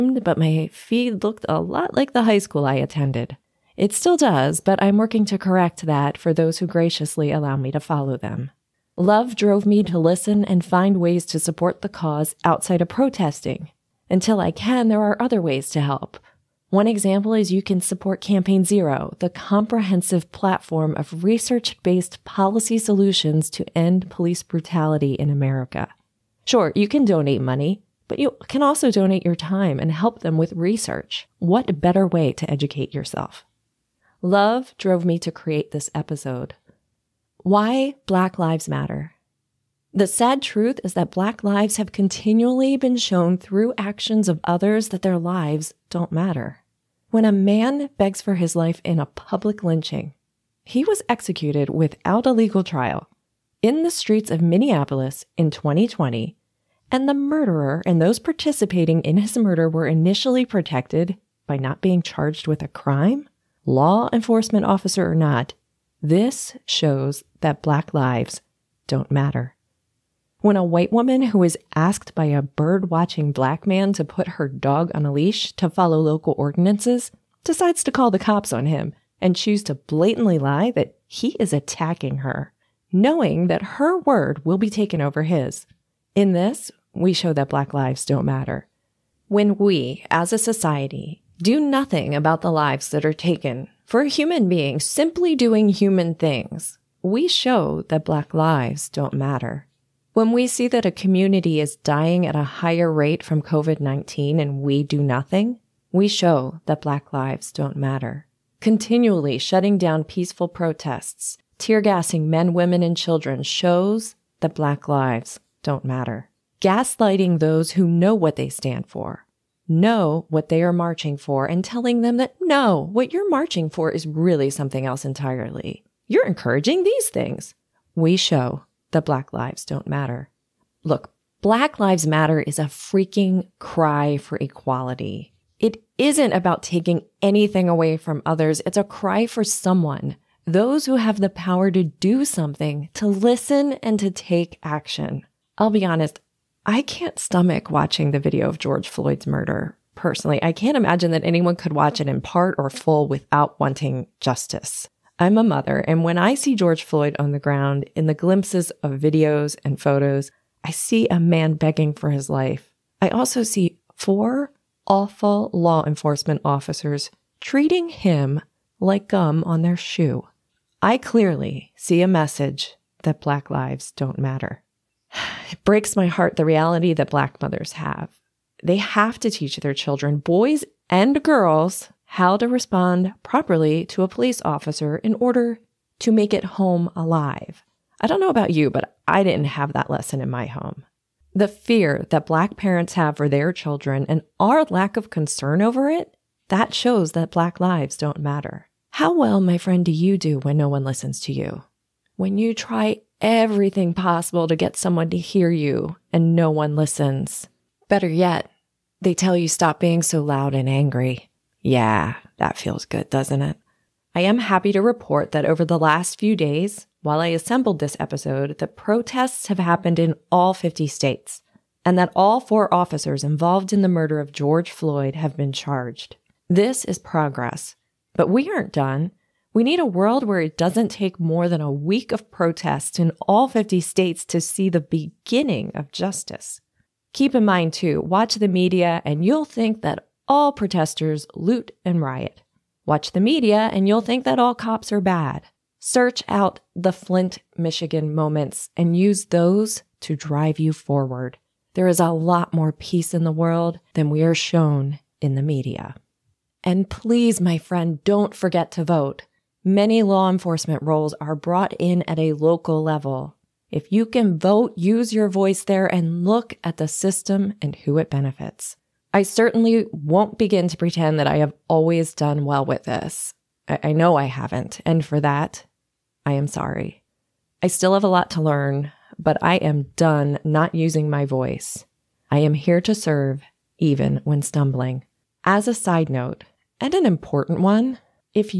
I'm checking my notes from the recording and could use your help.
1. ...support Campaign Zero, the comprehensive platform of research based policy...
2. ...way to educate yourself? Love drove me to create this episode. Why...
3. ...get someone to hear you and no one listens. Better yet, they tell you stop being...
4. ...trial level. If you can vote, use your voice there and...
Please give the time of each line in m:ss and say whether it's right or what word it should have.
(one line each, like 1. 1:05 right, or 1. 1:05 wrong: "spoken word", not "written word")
1. 0:17 right
2. 0:32 right
3. 3:24 right
4. 4:22 wrong: "local", not "trial".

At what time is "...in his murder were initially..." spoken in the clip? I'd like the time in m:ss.
0:59.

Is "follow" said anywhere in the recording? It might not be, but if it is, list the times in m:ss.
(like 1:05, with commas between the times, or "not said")
0:07, 1:15.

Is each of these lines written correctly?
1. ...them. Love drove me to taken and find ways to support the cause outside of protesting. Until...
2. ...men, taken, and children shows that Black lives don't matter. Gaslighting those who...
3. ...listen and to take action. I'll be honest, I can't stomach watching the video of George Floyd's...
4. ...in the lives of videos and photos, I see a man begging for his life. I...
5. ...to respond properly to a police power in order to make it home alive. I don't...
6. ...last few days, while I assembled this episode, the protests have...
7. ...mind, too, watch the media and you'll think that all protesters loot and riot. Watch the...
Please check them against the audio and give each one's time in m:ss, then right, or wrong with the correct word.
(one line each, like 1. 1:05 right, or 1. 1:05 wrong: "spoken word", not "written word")
1. 0:08 wrong: "listen", not "taken"
2. 1:52 wrong: "women", not "taken"
3. 2:23 right
4. 2:37 wrong: "glimpses", not "lives"
5. 3:02 wrong: "officer", not "power"
6. 3:35 right
7. 3:57 right.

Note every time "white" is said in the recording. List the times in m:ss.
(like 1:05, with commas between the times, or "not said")
1:10.